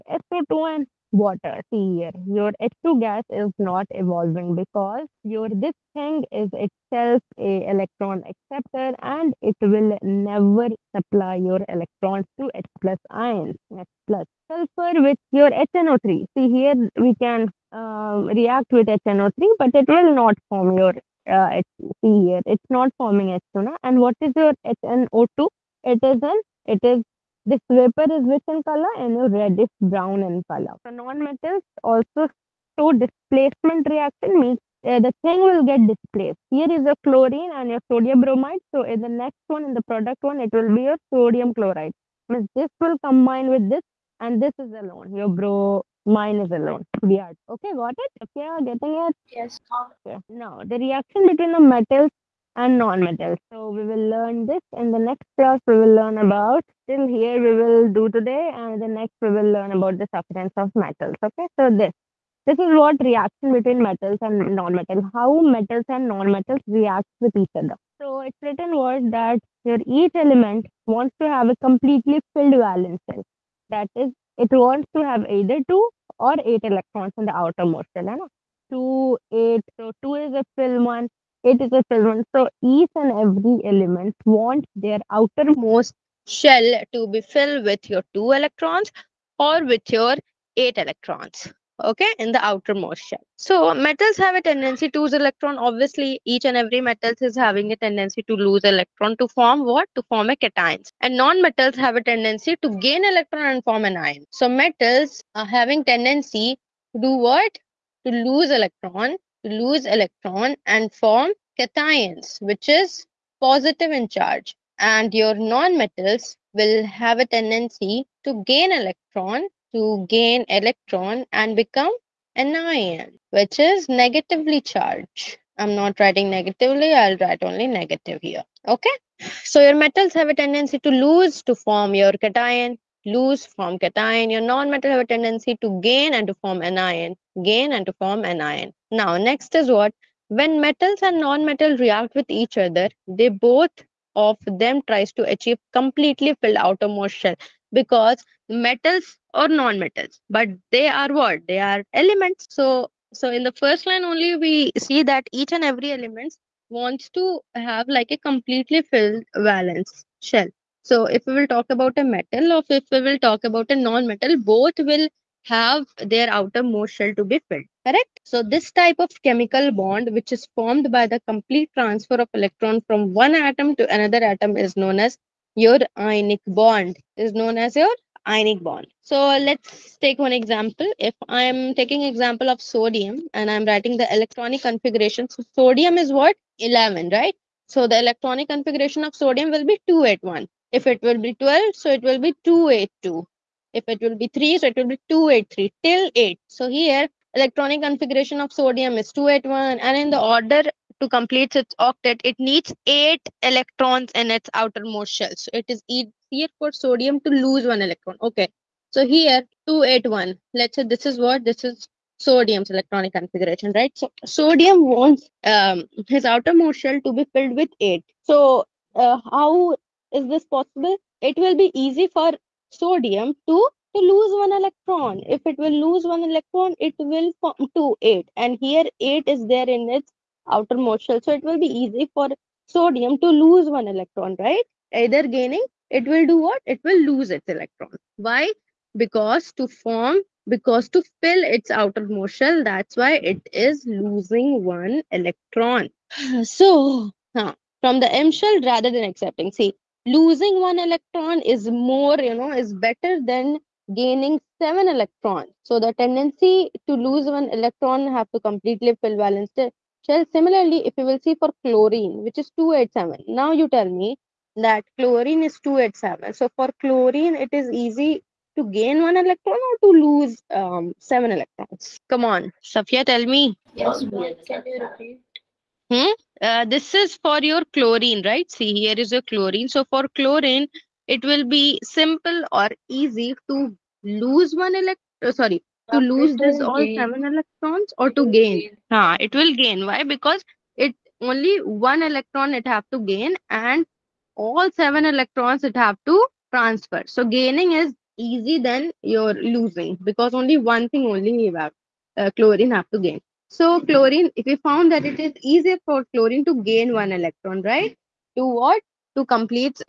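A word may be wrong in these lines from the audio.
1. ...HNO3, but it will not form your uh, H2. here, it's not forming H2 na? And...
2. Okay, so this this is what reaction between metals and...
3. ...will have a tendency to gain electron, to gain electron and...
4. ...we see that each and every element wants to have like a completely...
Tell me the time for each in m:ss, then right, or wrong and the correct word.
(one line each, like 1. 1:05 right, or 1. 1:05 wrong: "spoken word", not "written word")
1. 0:18 right
2. 1:01 right
3. 1:56 right
4. 2:34 right.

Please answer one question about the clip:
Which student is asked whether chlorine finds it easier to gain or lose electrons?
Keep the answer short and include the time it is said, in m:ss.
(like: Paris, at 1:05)
Safiya, at 4:32.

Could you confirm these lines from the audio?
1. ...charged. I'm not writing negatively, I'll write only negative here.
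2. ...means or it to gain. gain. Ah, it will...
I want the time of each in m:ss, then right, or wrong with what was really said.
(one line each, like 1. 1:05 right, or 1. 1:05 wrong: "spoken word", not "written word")
1. 2:04 right
2. 4:47 wrong: "electrons", not "means".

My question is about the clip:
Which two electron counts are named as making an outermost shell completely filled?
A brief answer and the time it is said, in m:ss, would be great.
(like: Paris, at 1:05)
2 or 8, at 1:15.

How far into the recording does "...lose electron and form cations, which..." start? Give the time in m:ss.
1:49.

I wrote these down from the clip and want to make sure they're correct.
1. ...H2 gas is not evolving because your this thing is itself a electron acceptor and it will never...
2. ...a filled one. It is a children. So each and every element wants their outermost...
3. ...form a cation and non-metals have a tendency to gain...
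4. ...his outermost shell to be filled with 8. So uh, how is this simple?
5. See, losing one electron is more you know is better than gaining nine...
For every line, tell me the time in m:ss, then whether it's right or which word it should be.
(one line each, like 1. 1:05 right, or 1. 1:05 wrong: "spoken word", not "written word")
1. 0:02 right
2. 1:20 right
3. 1:40 right
4. 3:36 wrong: "possible", not "simple"
5. 4:09 wrong: "seven", not "nine".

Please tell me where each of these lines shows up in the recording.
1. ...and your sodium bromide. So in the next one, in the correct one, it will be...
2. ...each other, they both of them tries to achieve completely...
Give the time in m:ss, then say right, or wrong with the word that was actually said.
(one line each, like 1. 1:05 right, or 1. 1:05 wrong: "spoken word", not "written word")
1. 0:37 wrong: "product", not "correct"
2. 2:22 right.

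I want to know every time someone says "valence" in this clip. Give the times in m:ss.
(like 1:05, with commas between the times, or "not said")
1:12, 2:39, 4:19.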